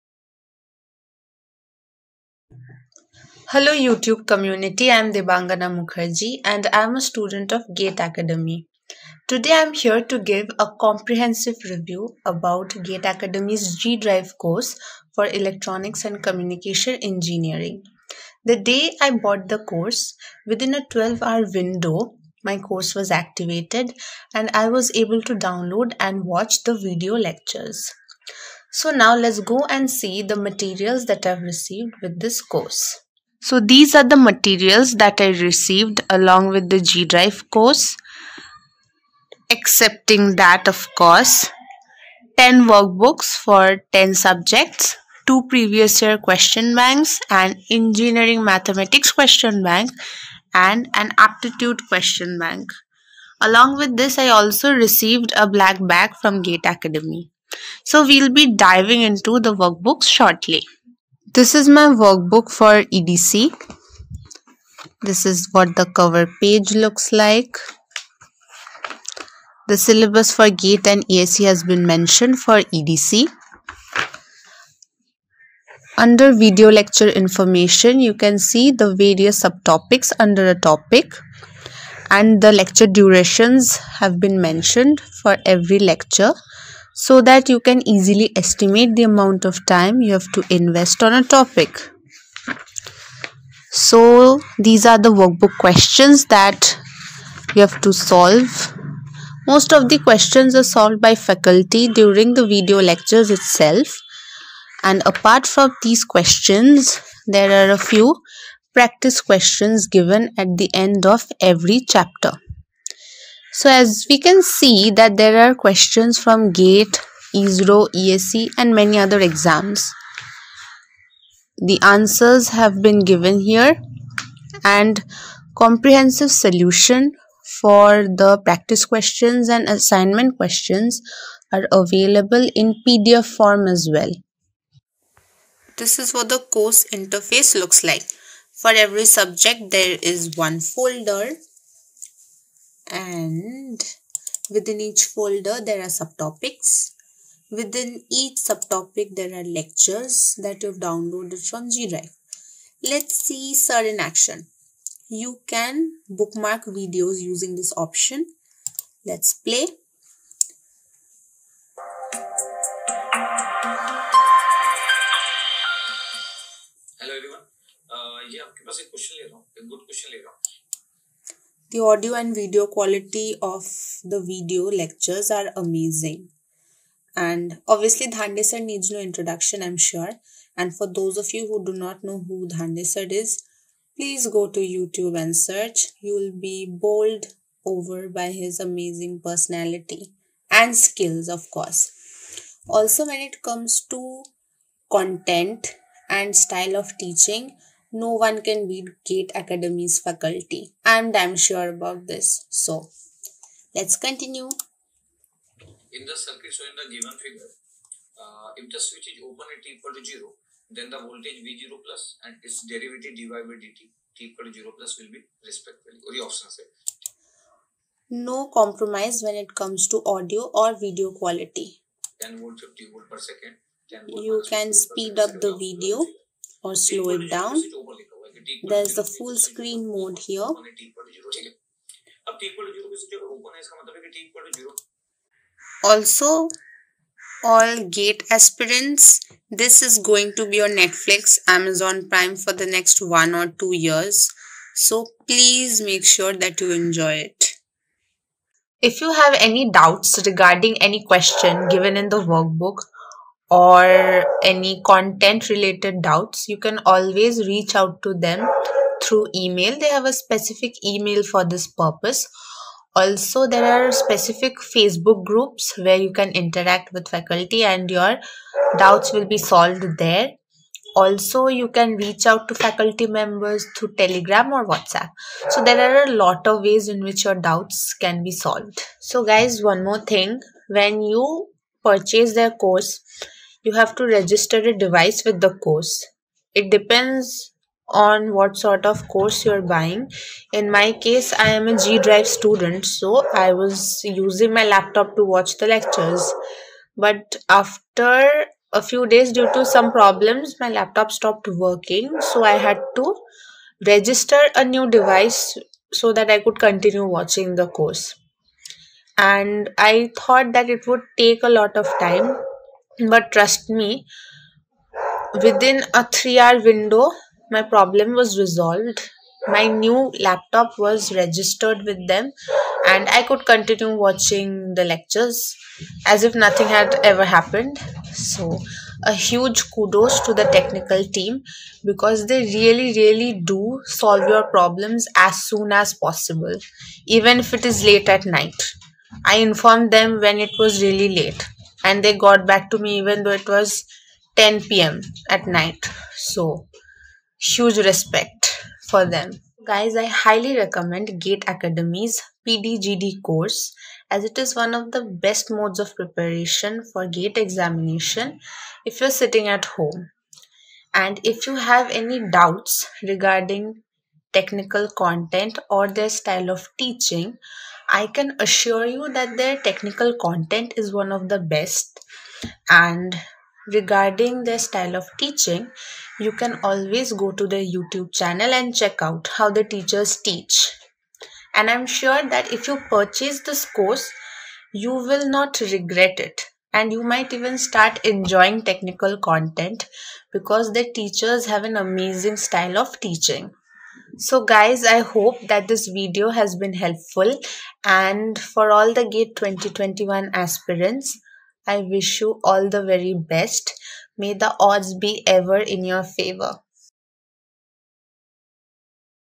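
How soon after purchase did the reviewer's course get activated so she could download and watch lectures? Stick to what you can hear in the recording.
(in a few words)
Within 12 hours.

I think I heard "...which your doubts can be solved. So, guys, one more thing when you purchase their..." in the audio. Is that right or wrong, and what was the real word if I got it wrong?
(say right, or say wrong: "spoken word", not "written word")
right.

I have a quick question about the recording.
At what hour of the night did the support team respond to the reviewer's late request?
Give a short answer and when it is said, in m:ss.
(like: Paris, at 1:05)
10 p.m., at 5:44.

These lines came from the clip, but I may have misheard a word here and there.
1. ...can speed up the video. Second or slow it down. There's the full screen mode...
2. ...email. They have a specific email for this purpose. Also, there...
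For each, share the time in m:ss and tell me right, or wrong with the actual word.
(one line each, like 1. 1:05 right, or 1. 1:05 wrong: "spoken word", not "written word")
1. 3:44 right
2. 4:19 right.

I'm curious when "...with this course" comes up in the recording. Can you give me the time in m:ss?
0:32.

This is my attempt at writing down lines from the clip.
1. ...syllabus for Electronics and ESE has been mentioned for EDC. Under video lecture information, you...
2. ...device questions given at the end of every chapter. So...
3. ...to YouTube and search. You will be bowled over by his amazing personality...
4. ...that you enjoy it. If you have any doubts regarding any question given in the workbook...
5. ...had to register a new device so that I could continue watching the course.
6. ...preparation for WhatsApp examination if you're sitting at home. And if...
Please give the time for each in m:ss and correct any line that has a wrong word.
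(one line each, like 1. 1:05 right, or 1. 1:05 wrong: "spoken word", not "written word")
1. 1:09 wrong: "GATE", not "Electronics"
2. 1:48 wrong: "practice", not "device"
3. 3:04 right
4. 4:06 right
5. 5:02 right
6. 5:55 wrong: "GATE", not "WhatsApp".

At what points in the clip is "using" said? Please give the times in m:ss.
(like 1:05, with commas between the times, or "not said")
2:37, 4:54.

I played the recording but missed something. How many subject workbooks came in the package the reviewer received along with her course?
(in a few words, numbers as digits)
10.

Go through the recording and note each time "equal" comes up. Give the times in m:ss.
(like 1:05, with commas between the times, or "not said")
3:29, 3:34.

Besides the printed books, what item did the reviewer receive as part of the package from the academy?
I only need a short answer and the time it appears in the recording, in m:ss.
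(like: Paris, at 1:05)
A black bag, at 0:55.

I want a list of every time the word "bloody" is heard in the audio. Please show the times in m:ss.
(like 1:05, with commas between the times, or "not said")
not said.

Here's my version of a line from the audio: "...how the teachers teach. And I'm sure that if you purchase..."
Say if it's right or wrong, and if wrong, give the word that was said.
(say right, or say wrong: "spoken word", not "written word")
right.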